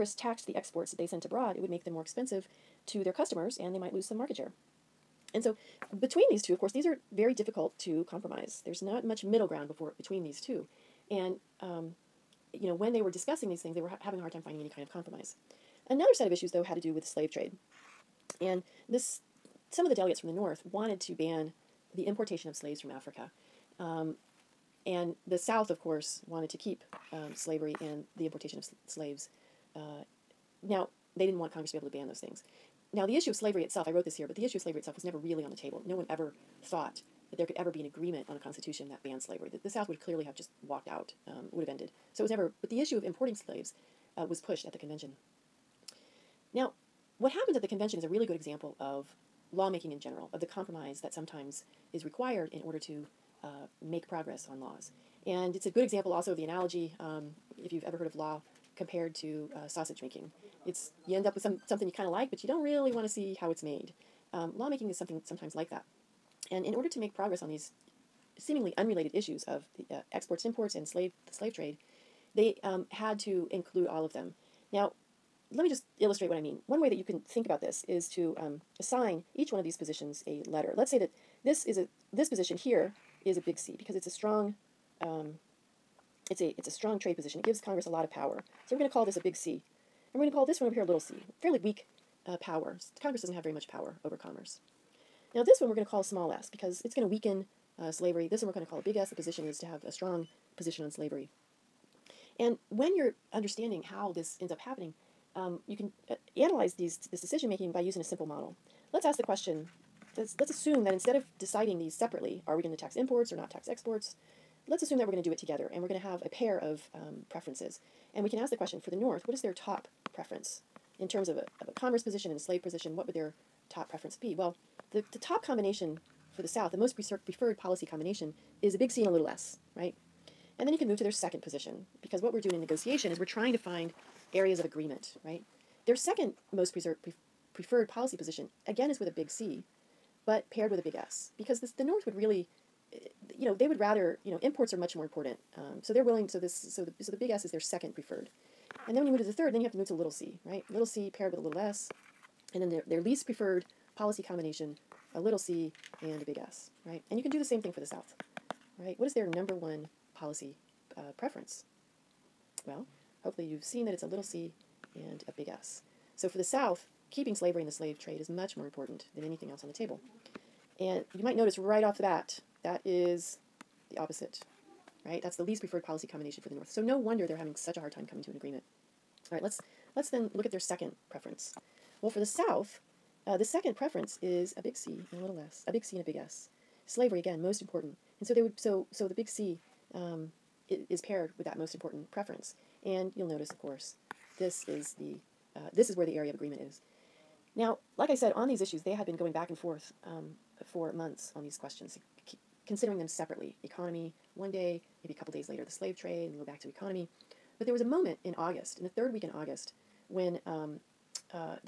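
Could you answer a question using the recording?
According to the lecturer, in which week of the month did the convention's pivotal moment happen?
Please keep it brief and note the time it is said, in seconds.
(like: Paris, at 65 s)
Third week, at 208 s.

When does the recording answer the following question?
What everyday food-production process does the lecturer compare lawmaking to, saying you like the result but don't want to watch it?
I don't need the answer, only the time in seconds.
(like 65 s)
59 s.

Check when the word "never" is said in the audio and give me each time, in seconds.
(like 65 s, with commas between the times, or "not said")
35 s, 42 s.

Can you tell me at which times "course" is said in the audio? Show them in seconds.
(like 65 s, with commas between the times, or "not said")
6 s, 25 s, 193 s.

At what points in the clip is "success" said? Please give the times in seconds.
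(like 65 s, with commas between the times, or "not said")
not said.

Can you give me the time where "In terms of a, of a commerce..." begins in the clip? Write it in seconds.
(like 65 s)
120 s.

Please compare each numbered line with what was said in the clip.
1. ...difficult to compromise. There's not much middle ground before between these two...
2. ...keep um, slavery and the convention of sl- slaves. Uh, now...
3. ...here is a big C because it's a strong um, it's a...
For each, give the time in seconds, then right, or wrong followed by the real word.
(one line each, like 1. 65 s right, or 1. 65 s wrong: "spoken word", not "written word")
1. 7 s right
2. 26 s wrong: "importation", not "convention"
3. 82 s right.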